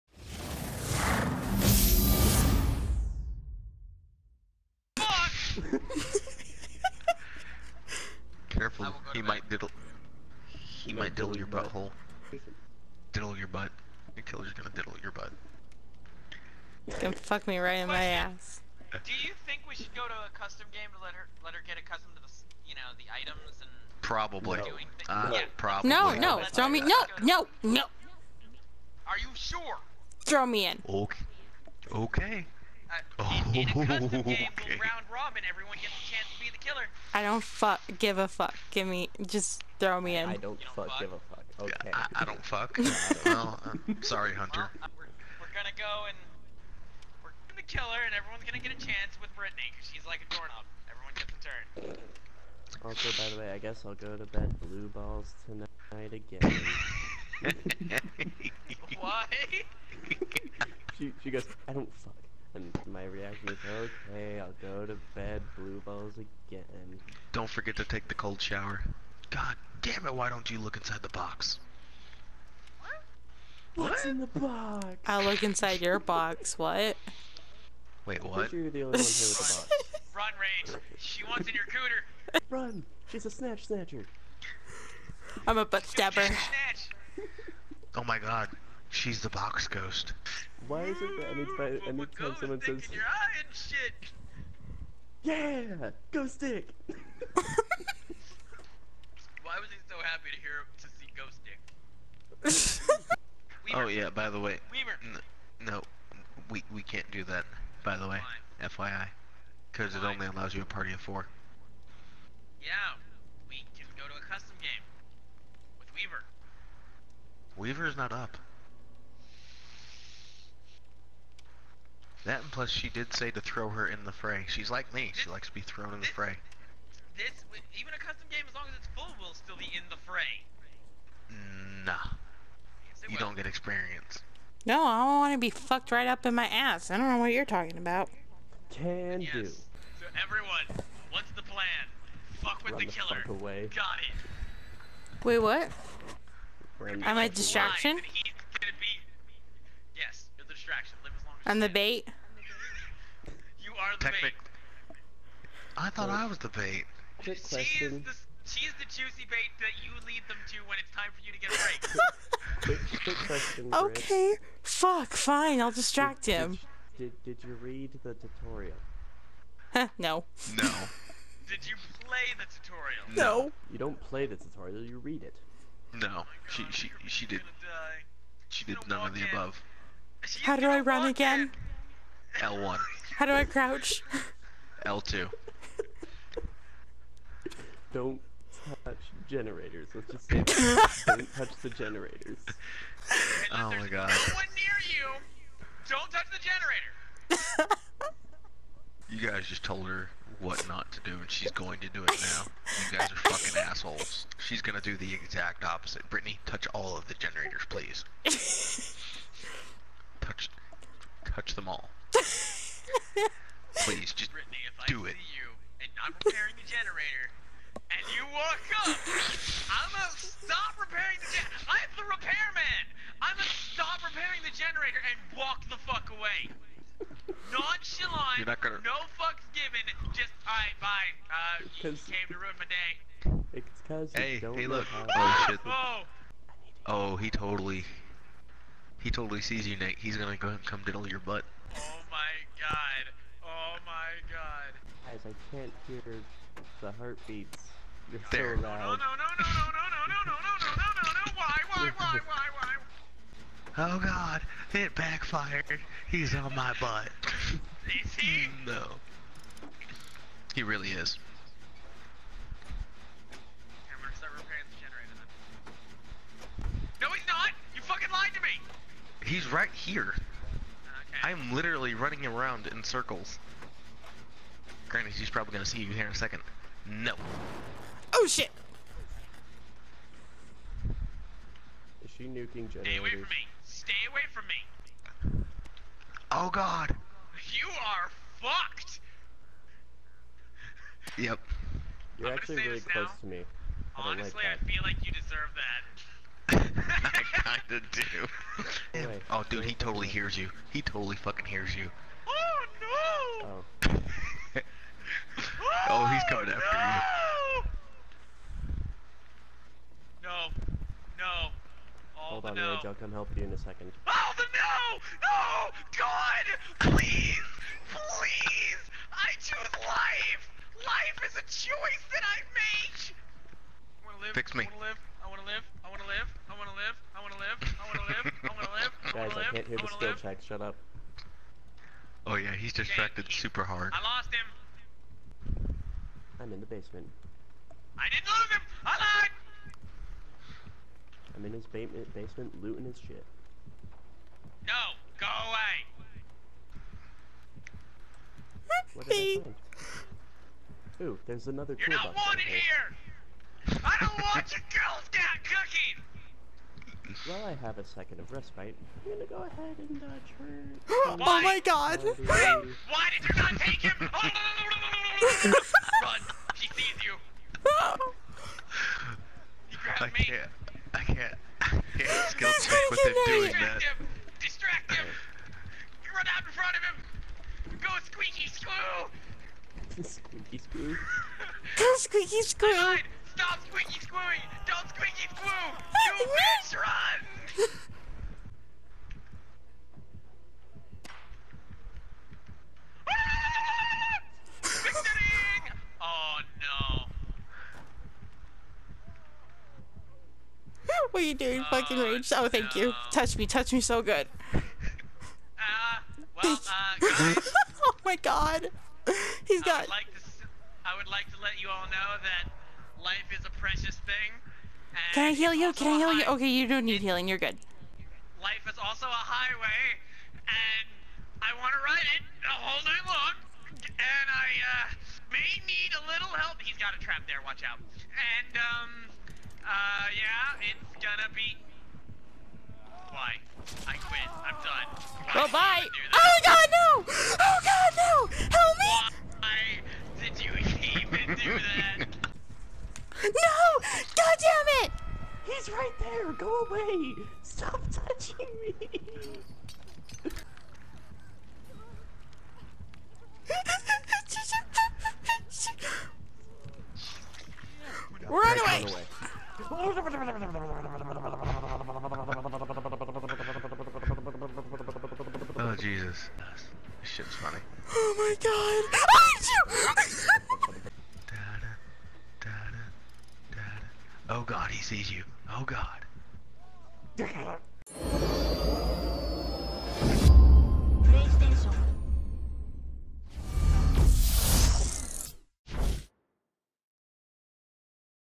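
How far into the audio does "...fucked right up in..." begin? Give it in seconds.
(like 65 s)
135 s.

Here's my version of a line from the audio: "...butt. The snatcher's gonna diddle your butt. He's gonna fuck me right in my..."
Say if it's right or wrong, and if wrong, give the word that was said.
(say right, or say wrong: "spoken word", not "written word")
wrong: "killer", not "snatcher".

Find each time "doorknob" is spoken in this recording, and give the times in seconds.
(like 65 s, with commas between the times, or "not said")
50 s.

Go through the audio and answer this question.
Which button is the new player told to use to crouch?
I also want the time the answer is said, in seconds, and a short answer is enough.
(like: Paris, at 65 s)
L2, at 184 s.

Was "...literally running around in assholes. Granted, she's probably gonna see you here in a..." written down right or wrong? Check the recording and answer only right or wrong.
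wrong.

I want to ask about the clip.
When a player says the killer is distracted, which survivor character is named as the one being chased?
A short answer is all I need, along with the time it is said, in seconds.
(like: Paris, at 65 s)
Jake, at 333 s.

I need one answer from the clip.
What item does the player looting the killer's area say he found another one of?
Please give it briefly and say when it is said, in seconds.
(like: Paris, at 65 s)
Toolbox, at 351 s.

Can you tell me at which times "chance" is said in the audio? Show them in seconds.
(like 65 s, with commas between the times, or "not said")
48 s.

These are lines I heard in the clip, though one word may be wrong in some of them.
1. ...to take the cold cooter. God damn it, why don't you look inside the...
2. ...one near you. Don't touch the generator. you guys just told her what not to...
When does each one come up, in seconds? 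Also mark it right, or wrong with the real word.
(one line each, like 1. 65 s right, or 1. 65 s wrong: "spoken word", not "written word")
1. 67 s wrong: "shower", not "cooter"
2. 194 s right.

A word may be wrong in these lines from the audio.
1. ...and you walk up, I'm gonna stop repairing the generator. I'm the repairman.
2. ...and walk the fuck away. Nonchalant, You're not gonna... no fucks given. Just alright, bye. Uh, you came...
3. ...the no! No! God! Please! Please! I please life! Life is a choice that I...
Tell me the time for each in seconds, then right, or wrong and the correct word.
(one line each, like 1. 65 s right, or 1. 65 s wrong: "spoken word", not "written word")
1. 217 s right
2. 225 s right
3. 314 s wrong: "choose", not "please".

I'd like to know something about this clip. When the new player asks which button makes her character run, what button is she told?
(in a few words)
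L1.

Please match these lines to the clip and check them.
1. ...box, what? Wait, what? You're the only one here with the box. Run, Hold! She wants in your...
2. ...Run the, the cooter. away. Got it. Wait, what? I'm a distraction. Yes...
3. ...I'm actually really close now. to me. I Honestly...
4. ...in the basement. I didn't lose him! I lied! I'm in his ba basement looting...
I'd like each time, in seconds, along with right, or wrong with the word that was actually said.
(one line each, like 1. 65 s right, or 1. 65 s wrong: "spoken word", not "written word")
1. 75 s wrong: "Rage", not "Hold"
2. 142 s wrong: "killer", not "cooter"
3. 292 s right
4. 336 s right.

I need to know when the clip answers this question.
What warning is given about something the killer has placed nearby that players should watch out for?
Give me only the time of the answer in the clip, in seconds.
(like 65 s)
426 s.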